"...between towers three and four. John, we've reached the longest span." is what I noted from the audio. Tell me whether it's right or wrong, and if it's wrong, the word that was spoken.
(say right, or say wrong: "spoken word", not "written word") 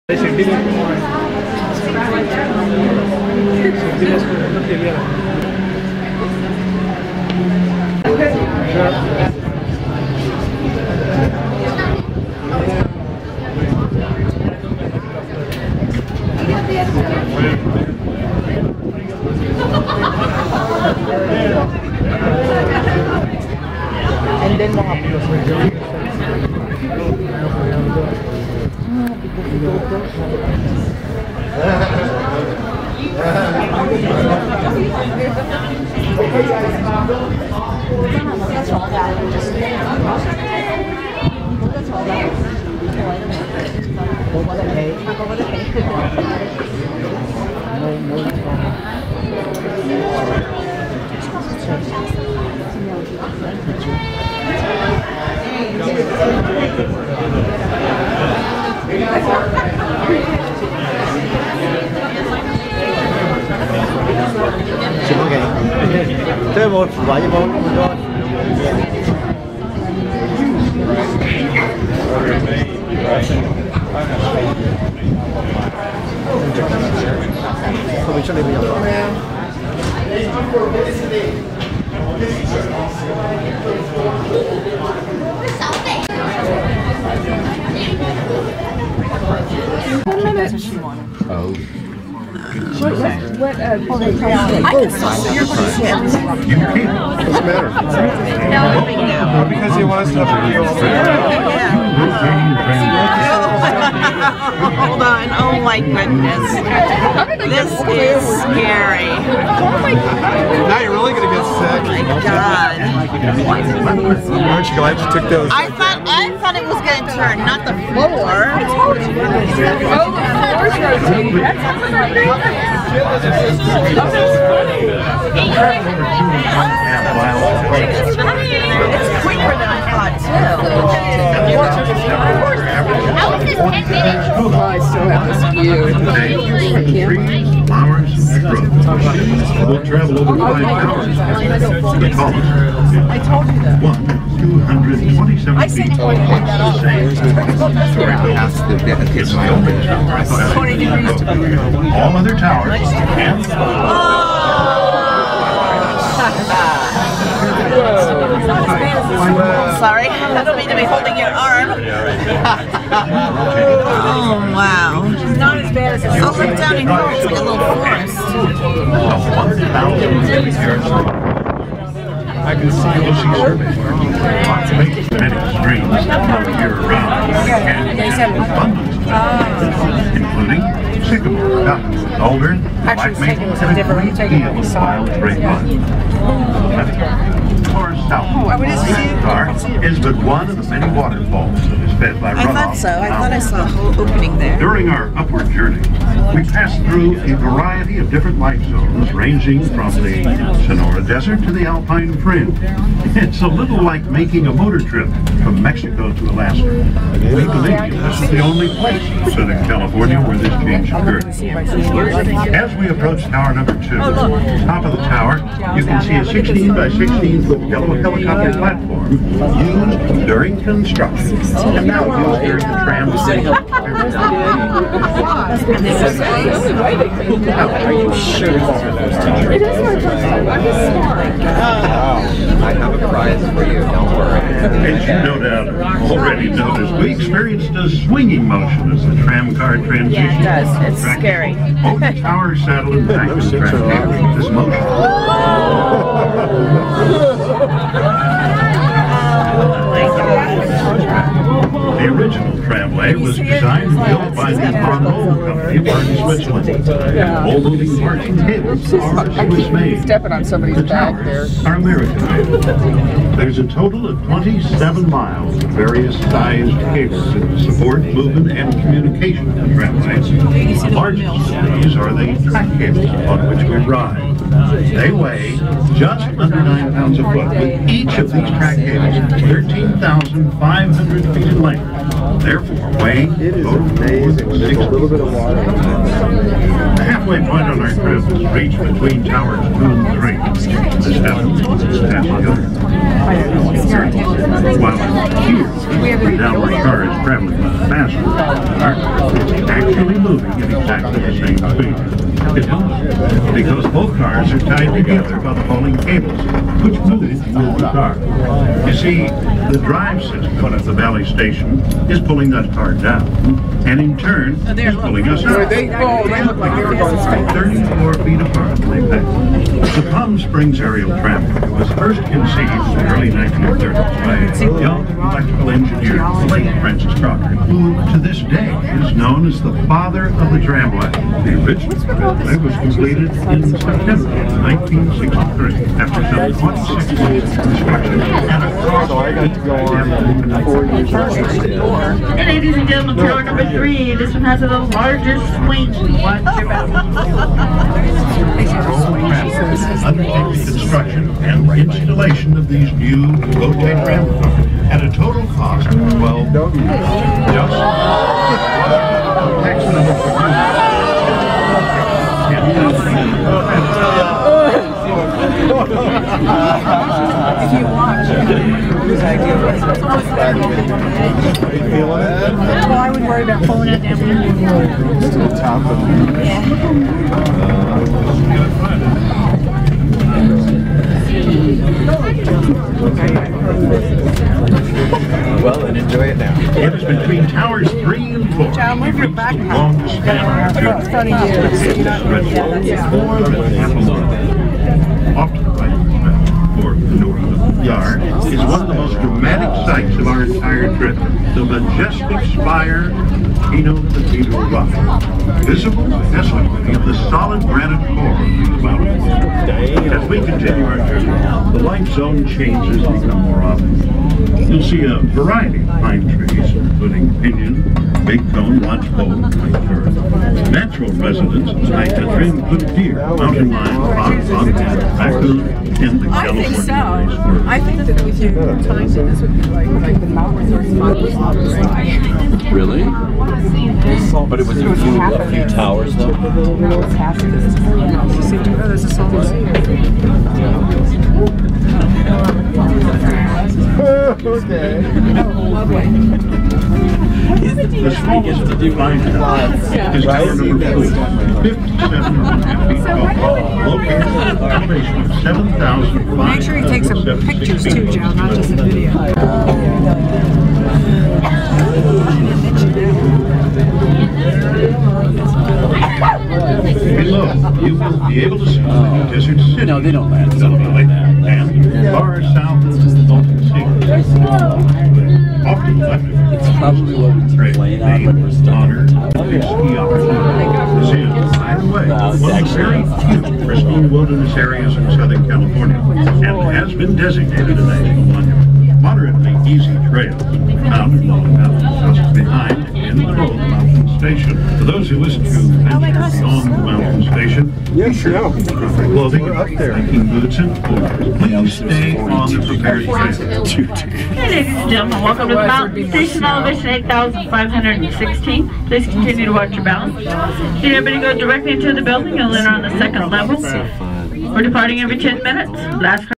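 right.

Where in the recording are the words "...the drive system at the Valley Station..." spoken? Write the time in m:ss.
5:09.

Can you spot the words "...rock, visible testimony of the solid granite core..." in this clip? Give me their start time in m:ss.
6:44.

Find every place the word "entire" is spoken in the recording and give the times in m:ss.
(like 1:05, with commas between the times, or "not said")
6:40.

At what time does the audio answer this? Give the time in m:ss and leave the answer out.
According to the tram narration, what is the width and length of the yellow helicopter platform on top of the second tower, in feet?
3:36.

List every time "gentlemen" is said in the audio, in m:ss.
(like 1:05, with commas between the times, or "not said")
5:42, 8:24.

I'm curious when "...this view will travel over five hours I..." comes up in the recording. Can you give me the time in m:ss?
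2:16.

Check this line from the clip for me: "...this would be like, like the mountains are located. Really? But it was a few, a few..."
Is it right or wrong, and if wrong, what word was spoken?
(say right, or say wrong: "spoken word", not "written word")
wrong: "spotted", not "located".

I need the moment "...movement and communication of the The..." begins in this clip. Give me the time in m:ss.
4:28.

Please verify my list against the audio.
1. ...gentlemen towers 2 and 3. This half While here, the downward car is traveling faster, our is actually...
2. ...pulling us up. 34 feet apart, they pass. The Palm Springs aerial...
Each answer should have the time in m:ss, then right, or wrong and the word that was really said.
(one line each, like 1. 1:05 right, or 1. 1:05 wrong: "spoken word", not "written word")
1. 4:48 wrong: "between", not "gentlemen"
2. 5:14 right.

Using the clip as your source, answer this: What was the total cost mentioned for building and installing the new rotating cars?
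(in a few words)
12 million.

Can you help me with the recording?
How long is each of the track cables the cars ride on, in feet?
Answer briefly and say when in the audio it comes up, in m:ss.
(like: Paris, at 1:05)
13,500, at 4:39.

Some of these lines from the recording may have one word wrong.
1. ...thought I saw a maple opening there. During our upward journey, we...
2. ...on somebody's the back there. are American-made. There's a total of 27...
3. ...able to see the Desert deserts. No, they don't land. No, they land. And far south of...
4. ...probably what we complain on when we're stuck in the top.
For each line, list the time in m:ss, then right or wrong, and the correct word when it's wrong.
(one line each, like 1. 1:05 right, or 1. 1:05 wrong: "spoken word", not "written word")
1. 3:13 wrong: "whole", not "maple"
2. 4:20 right
3. 7:48 right
4. 7:56 right.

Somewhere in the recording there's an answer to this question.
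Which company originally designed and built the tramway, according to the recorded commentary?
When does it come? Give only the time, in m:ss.
4:14.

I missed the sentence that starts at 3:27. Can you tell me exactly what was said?
We believe this is the only place in Southern California where this change occurred.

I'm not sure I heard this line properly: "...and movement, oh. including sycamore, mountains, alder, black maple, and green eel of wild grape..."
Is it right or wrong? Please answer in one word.
wrong.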